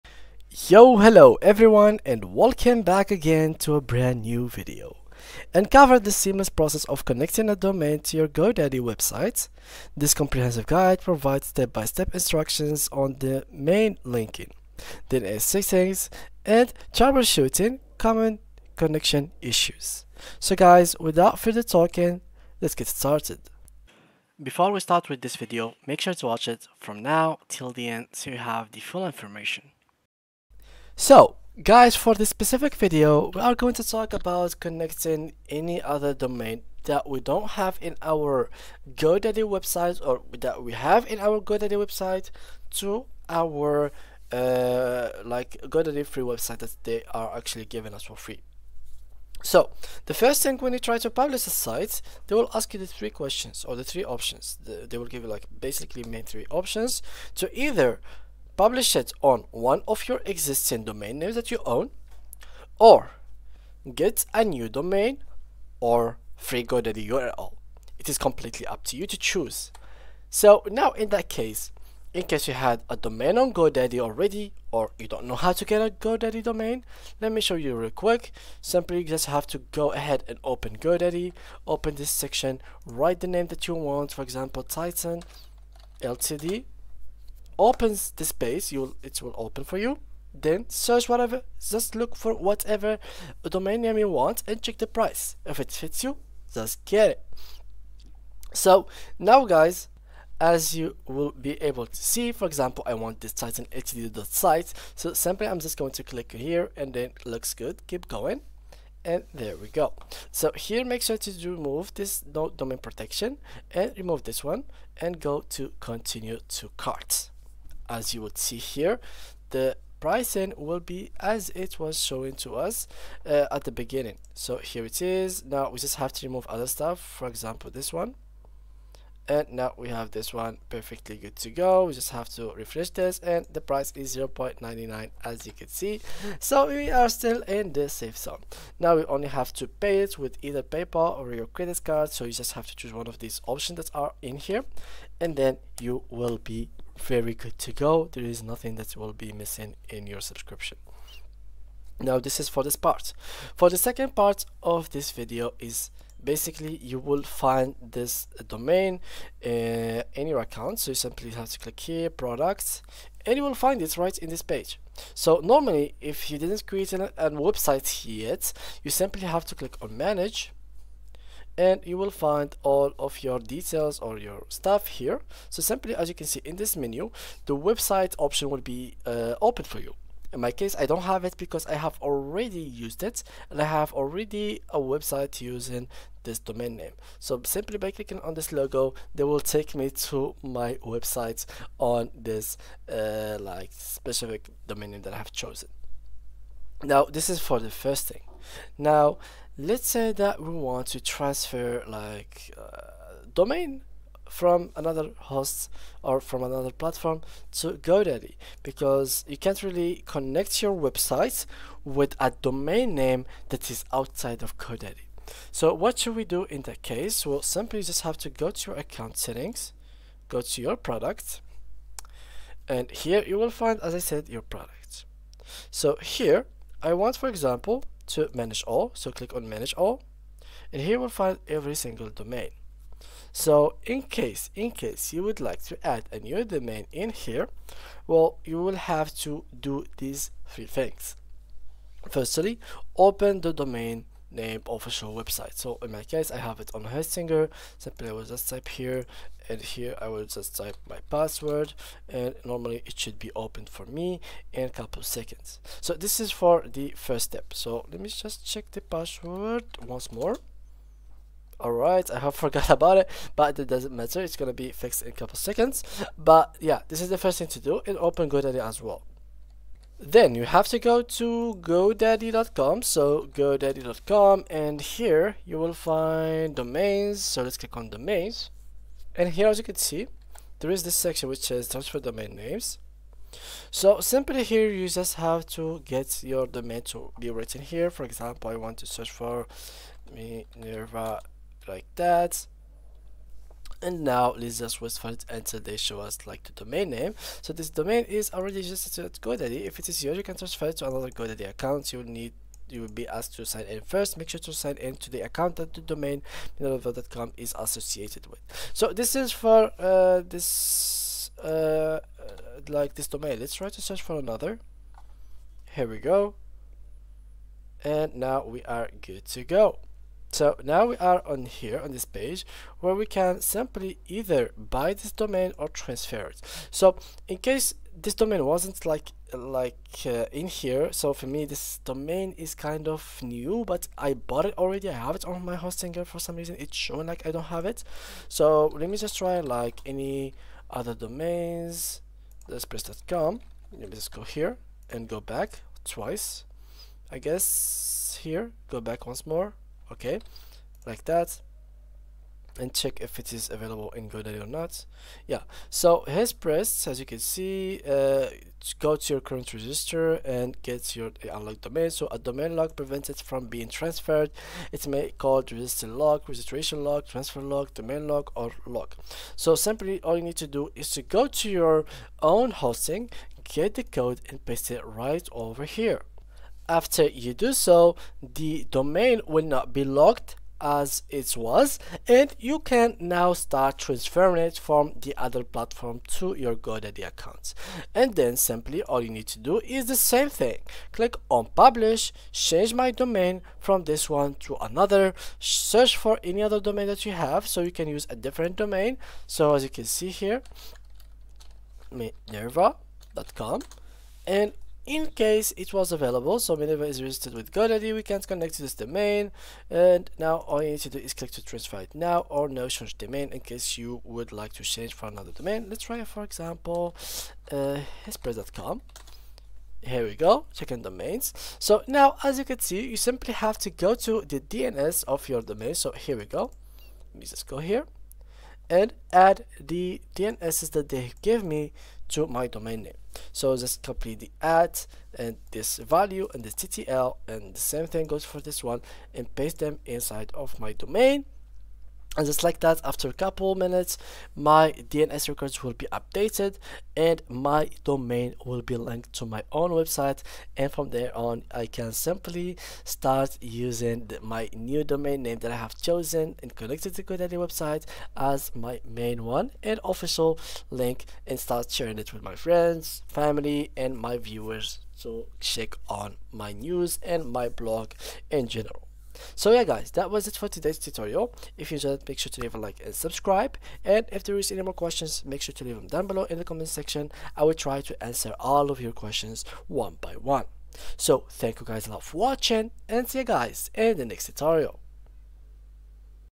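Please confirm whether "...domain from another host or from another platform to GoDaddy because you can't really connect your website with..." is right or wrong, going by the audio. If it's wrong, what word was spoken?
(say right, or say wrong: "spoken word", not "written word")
right.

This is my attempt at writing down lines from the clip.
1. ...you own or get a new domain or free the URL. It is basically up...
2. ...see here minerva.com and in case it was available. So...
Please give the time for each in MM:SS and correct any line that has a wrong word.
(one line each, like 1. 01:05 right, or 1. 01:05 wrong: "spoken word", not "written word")
1. 01:01 wrong: "completely", not "basically"
2. 06:39 right.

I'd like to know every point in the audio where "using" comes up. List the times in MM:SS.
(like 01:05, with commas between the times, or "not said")
03:05, 07:33.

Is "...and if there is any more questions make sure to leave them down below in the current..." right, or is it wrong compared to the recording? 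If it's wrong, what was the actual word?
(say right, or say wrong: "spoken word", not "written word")
wrong: "comment", not "current".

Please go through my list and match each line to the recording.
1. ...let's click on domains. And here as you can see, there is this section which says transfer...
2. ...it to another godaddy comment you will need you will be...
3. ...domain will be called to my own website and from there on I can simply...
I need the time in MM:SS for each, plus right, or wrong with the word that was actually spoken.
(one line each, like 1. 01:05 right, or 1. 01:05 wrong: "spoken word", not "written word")
1. 04:37 right
2. 05:00 wrong: "account", not "comment"
3. 07:27 wrong: "linked", not "called".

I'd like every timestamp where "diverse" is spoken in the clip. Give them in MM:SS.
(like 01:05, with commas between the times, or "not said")
not said.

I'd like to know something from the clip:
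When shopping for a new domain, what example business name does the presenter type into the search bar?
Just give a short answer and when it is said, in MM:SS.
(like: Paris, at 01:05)
Titan Ltd, at 01:24.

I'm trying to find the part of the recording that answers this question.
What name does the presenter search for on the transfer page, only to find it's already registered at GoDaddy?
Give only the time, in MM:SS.
04:50.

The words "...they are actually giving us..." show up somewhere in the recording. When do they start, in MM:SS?
00:46.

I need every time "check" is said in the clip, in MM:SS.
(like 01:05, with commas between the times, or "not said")
01:34, 04:18, 05:52, 07:45.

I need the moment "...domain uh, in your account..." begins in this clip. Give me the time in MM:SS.
02:38.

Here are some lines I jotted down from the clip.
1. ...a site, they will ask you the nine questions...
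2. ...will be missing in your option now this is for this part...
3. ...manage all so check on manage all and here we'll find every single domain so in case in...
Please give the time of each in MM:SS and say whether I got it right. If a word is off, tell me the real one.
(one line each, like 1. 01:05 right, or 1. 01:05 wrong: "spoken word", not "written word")
1. 00:51 wrong: "three", not "nine"
2. 02:28 wrong: "subscription", not "option"
3. 03:48 wrong: "click", not "check".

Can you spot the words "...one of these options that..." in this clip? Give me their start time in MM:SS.
02:22.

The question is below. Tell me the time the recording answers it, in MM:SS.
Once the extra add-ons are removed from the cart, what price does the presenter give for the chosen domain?
02:14.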